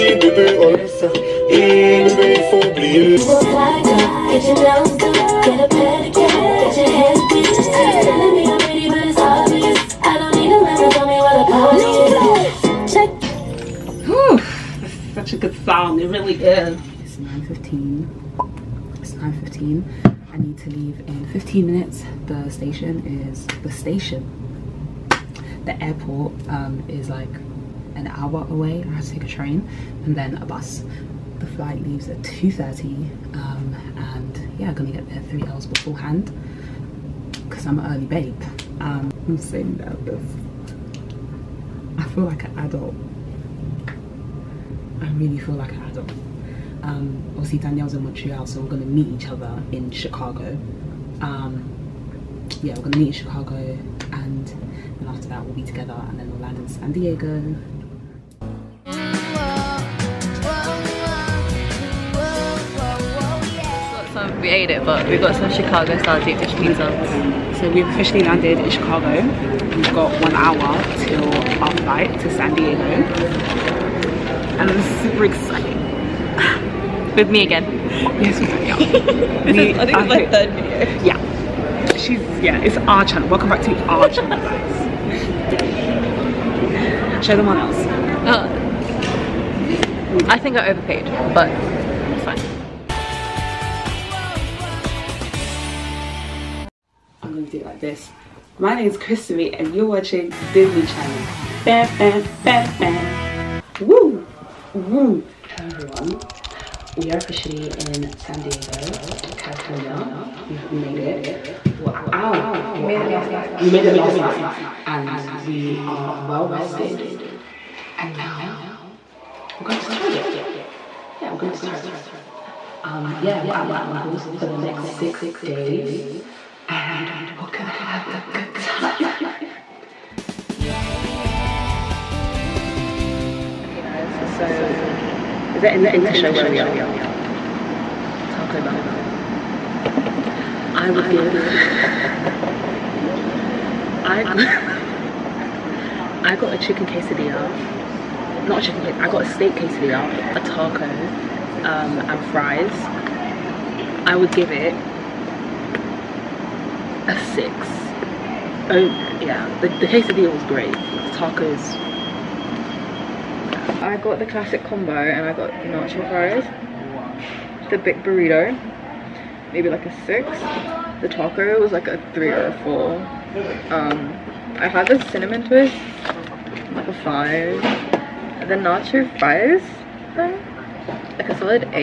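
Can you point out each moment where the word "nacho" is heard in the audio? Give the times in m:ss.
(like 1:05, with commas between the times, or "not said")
2:45, 2:58.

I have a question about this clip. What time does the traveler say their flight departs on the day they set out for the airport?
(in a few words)
2:30.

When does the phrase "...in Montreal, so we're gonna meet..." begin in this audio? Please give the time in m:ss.
0:47.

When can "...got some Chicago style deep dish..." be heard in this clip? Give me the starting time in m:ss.
1:05.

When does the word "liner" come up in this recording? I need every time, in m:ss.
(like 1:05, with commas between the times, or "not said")
not said.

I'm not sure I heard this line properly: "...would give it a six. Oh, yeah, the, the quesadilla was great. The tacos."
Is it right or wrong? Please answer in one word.
right.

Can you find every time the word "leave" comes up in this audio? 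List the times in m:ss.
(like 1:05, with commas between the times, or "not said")
0:20, 0:31.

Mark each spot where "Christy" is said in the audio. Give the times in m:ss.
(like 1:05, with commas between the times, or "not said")
1:38.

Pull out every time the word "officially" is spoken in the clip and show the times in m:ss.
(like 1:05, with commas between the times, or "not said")
1:07, 1:47.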